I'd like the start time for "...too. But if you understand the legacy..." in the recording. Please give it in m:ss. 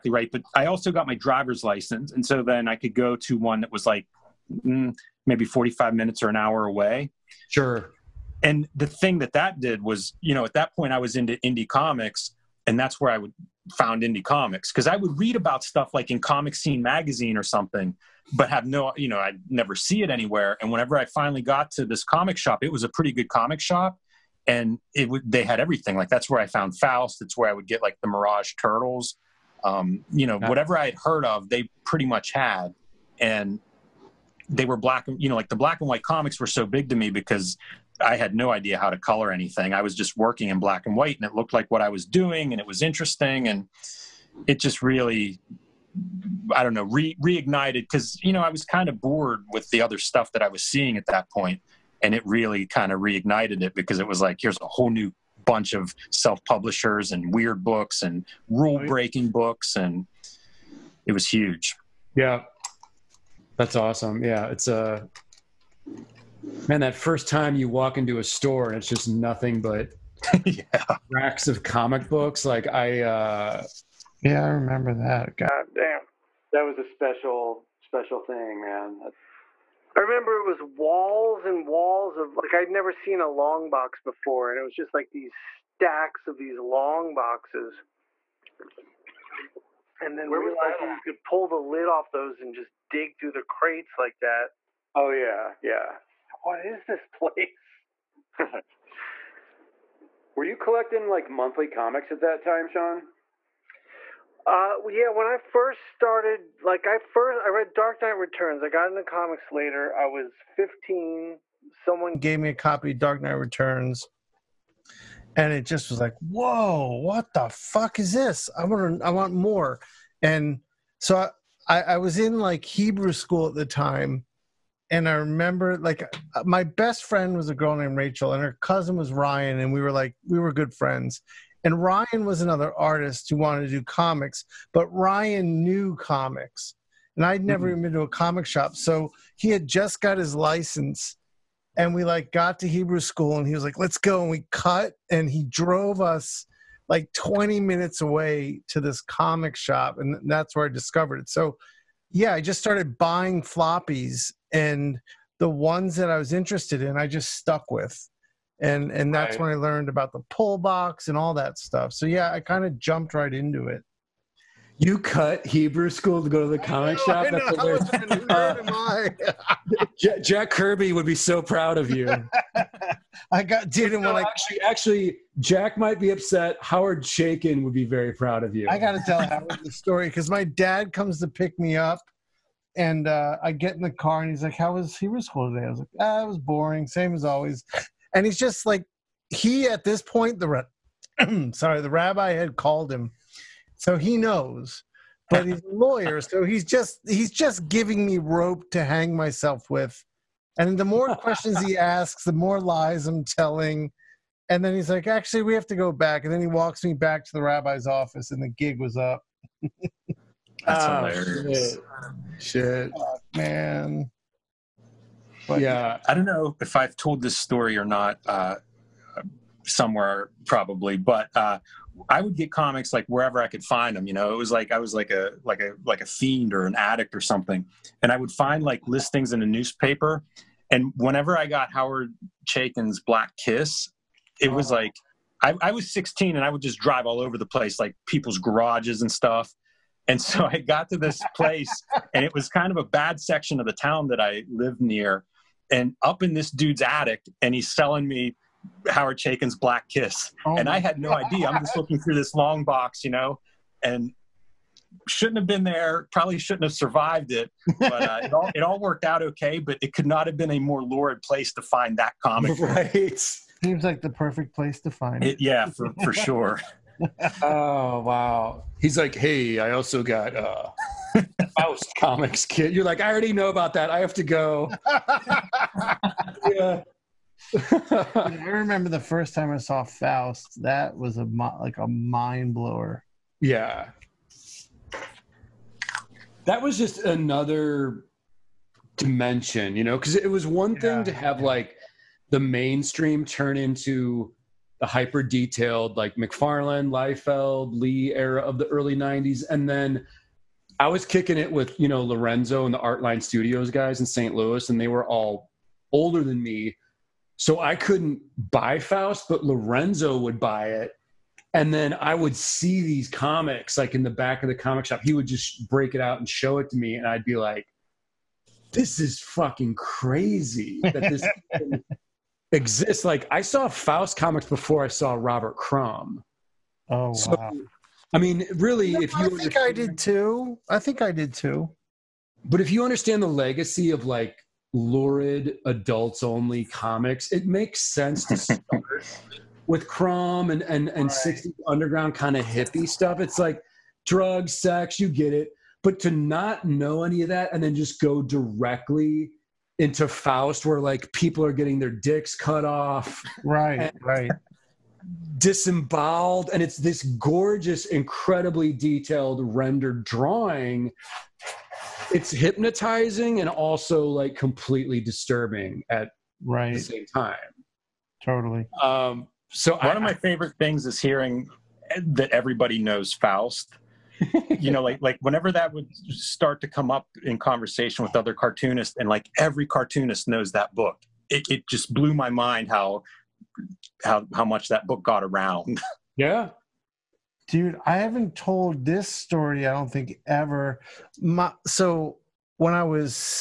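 5:31.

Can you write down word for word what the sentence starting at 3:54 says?
like I, I, was 16 and I would just drive all over the place, like people's garages and stuff.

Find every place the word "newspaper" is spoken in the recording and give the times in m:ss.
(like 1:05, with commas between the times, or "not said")
3:49.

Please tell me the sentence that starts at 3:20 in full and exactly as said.
And the more questions he asks, the more lies I'm telling.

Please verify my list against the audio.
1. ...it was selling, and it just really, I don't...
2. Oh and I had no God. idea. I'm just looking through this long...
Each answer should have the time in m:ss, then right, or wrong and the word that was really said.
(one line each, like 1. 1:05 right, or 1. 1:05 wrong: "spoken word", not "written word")
1. 0:42 wrong: "interesting", not "selling"
2. 4:10 right.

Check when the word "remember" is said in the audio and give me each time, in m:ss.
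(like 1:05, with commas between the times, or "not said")
1:14, 1:20, 2:05, 4:38.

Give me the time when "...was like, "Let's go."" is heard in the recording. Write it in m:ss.
2:23.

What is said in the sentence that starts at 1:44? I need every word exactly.
Uh, yeah, when I first started, like I first I read Dark Knight Returns.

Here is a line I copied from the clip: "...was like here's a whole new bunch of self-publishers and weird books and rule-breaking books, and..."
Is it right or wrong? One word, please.
right.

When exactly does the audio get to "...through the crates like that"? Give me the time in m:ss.
1:33.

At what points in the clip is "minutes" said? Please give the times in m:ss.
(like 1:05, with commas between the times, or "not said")
0:05, 2:27.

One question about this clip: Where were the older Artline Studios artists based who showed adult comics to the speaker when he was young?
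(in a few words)
St. Louis.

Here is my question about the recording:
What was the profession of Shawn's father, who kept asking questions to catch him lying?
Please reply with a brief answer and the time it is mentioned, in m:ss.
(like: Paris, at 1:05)
lawyer, at 3:15.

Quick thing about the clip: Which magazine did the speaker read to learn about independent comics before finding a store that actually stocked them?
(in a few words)
Comic Scene.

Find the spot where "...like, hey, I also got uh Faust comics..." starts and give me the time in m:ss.
4:28.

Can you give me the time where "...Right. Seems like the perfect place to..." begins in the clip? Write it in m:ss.
4:22.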